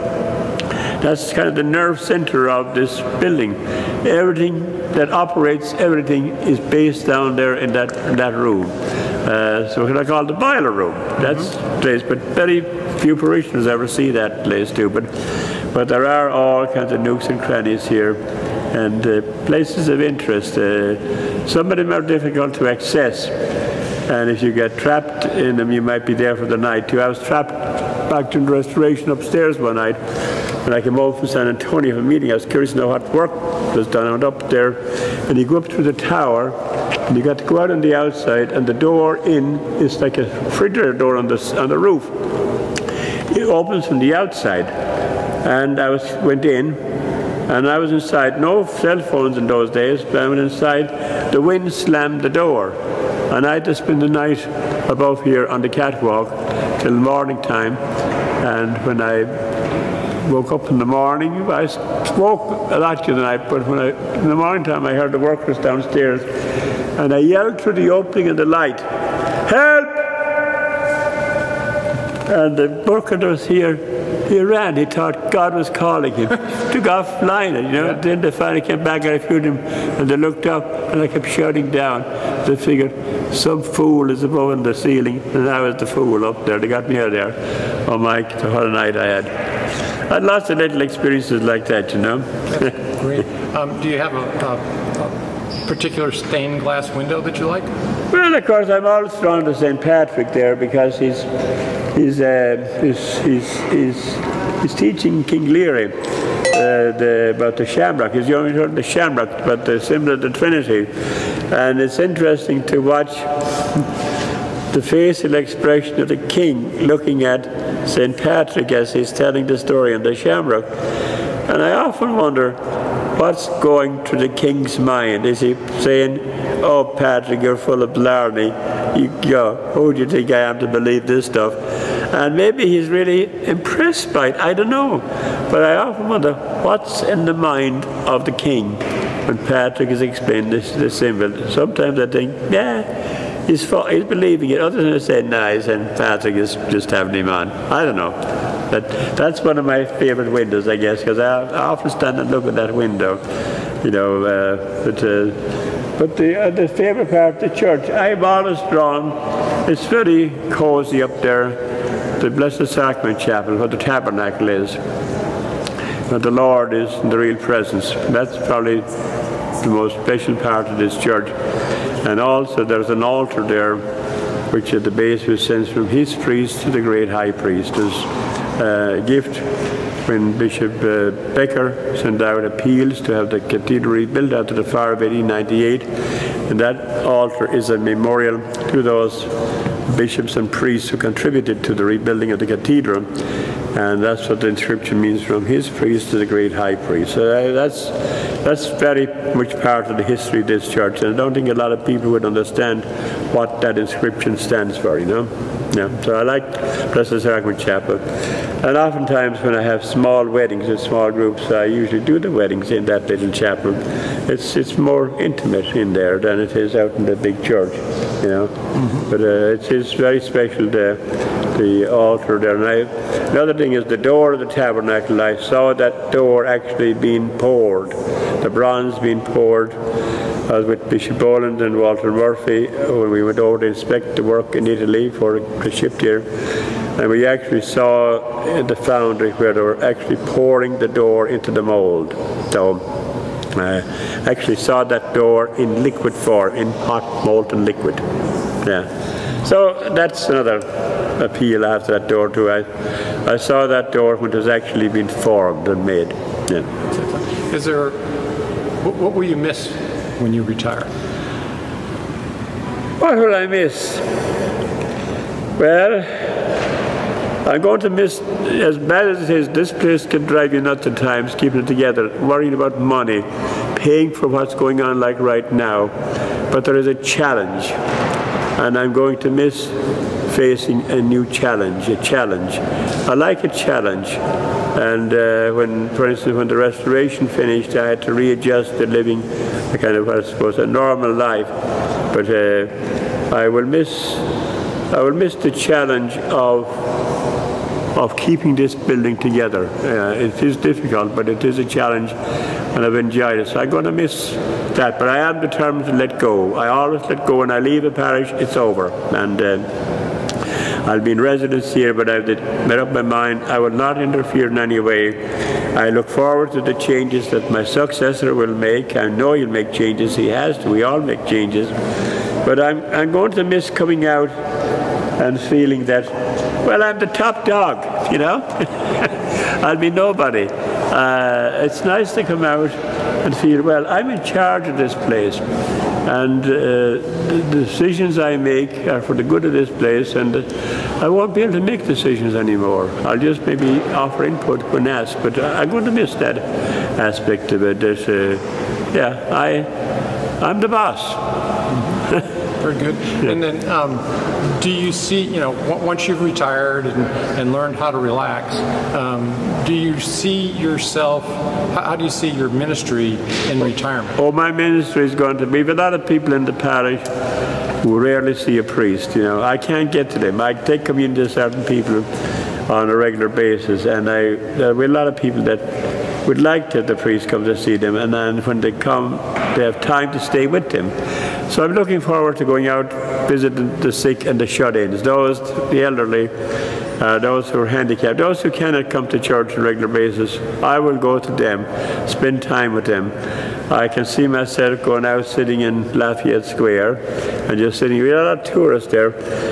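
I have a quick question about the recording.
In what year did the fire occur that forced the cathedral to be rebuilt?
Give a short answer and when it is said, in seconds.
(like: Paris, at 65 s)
1898, at 184 s.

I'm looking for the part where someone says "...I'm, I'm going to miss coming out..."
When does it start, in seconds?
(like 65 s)
322 s.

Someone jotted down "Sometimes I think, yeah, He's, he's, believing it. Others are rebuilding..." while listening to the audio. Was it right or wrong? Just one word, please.
wrong.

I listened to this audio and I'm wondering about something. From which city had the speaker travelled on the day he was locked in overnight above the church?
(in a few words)
San Antonio.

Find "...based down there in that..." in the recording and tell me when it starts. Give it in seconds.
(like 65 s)
6 s.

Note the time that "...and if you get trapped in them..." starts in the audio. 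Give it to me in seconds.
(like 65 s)
24 s.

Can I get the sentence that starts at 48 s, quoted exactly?
No cell phones in those days, but I went inside.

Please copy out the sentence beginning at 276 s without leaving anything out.
But there is a challenge, and I'm going to miss facing a new challenge, a challenge.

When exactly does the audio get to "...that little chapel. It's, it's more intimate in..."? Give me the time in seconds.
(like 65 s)
212 s.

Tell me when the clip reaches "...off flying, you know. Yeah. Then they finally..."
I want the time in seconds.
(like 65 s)
76 s.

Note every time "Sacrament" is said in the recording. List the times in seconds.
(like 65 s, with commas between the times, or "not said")
162 s, 207 s.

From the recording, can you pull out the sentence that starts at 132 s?
And maybe he's really impressed by it.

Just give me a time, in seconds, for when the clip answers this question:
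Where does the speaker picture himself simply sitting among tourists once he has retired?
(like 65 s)
395 s.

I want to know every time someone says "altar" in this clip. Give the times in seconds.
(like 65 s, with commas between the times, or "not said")
173 s, 187 s, 221 s.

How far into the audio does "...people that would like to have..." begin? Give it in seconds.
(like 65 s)
375 s.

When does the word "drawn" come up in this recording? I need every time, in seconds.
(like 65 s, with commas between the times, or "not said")
99 s, 158 s.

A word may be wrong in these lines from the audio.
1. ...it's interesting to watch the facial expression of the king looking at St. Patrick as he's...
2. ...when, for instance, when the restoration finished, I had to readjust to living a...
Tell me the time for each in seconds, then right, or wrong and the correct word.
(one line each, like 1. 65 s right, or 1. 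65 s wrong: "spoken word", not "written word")
1. 111 s right
2. 285 s right.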